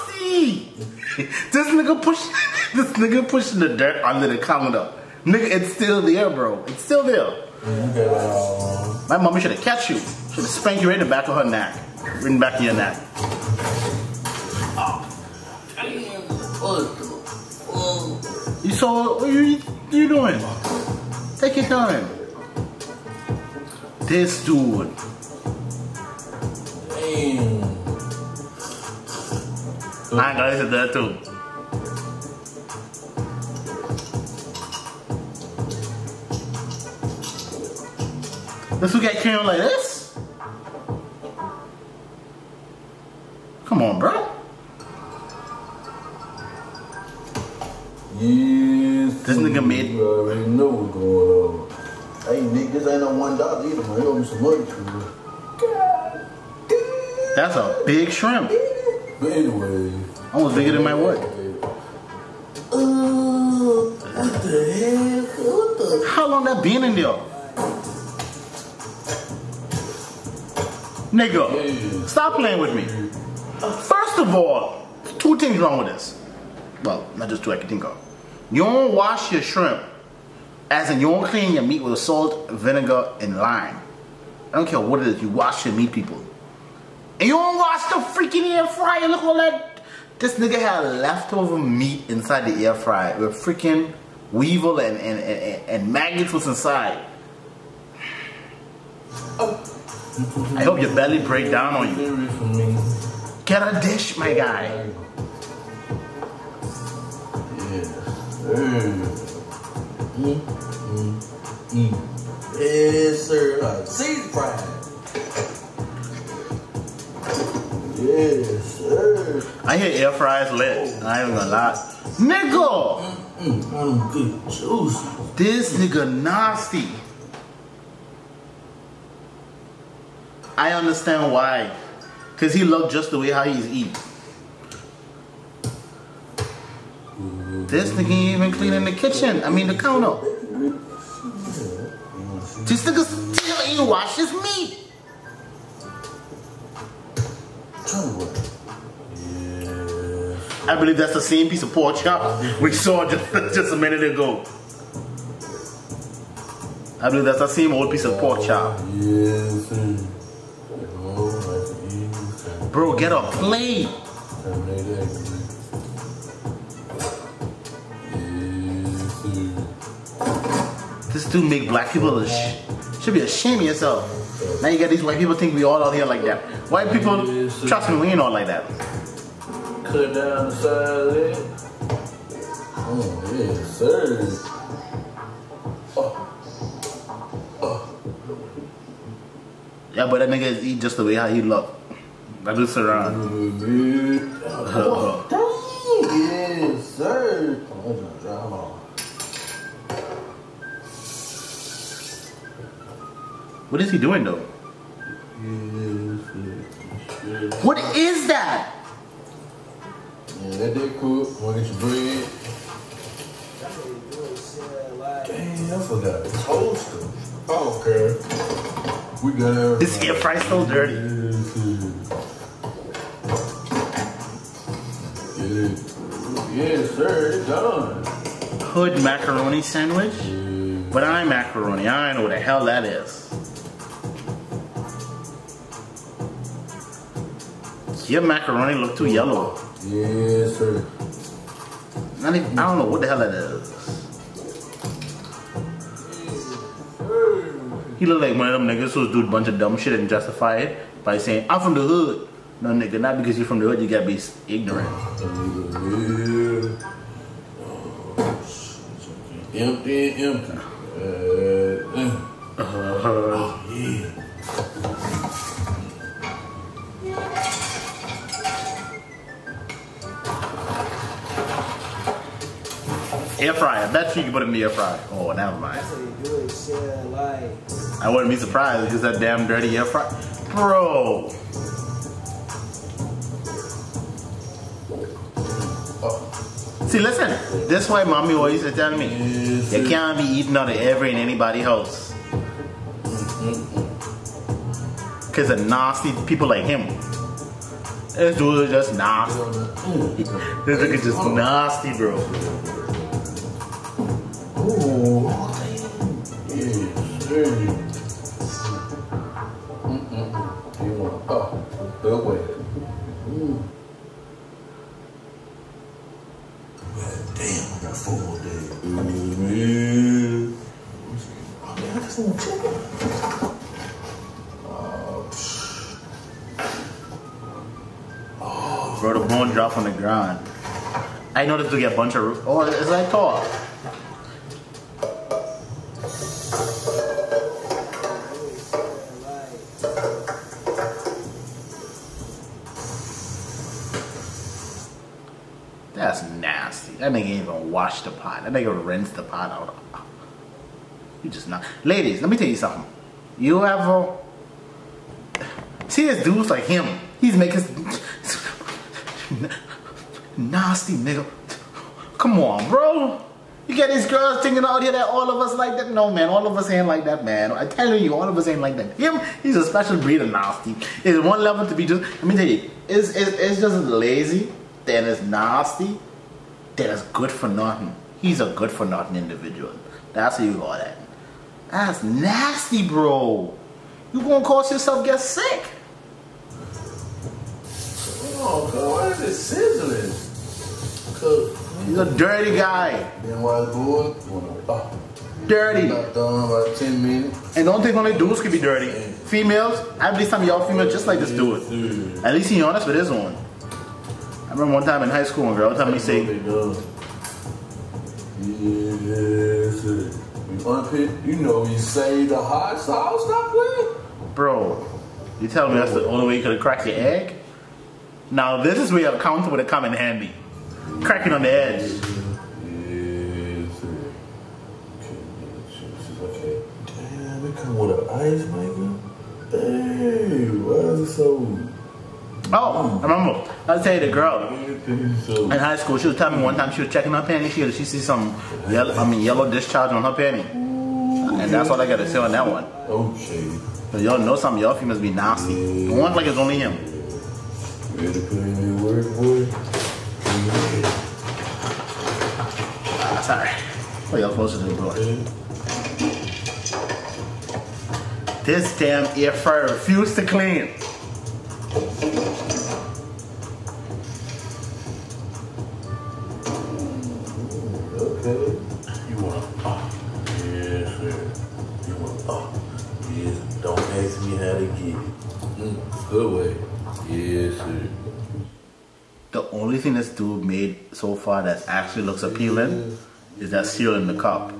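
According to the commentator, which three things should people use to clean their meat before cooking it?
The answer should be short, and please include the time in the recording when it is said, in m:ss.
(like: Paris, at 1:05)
salt, vinegar, and lime, at 1:21.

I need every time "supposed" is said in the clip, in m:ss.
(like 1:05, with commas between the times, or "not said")
7:34.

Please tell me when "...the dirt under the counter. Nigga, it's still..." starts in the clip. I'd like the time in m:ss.
0:03.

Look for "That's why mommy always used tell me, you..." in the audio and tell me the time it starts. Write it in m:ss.
4:47.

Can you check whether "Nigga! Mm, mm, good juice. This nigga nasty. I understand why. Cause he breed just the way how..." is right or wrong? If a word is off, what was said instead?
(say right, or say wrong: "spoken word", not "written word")
wrong: "looked", not "breed".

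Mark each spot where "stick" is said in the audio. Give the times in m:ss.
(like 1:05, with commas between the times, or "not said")
not said.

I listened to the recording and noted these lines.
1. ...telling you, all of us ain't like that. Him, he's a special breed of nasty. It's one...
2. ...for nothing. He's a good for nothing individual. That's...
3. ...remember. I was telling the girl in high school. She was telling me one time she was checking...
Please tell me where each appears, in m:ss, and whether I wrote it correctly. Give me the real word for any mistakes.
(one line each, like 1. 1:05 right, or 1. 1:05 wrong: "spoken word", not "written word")
1. 6:07 right
2. 6:17 right
3. 7:13 right.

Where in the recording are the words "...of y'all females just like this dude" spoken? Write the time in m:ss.
6:40.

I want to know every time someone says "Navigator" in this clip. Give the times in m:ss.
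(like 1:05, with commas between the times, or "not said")
not said.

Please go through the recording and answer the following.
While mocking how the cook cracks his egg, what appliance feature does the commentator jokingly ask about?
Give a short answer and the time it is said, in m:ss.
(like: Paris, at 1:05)
ice maker, at 7:08.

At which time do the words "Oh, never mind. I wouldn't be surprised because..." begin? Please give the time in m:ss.
4:35.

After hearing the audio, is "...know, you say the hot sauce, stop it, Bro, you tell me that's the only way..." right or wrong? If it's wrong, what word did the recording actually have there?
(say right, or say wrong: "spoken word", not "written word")
right.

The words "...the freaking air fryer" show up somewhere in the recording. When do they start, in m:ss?
1:27.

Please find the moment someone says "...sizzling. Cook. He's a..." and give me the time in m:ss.
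6:30.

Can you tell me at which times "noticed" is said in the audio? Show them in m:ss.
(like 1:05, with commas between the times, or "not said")
5:31.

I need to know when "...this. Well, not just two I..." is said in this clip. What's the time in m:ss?
1:15.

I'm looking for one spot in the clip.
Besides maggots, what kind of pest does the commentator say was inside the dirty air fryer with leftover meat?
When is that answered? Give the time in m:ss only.
1:34.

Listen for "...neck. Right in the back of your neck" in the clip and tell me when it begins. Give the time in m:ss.
0:11.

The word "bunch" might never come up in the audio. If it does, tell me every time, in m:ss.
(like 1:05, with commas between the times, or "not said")
4:09, 5:31.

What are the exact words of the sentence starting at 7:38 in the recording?
This damn air fryer refused to clean.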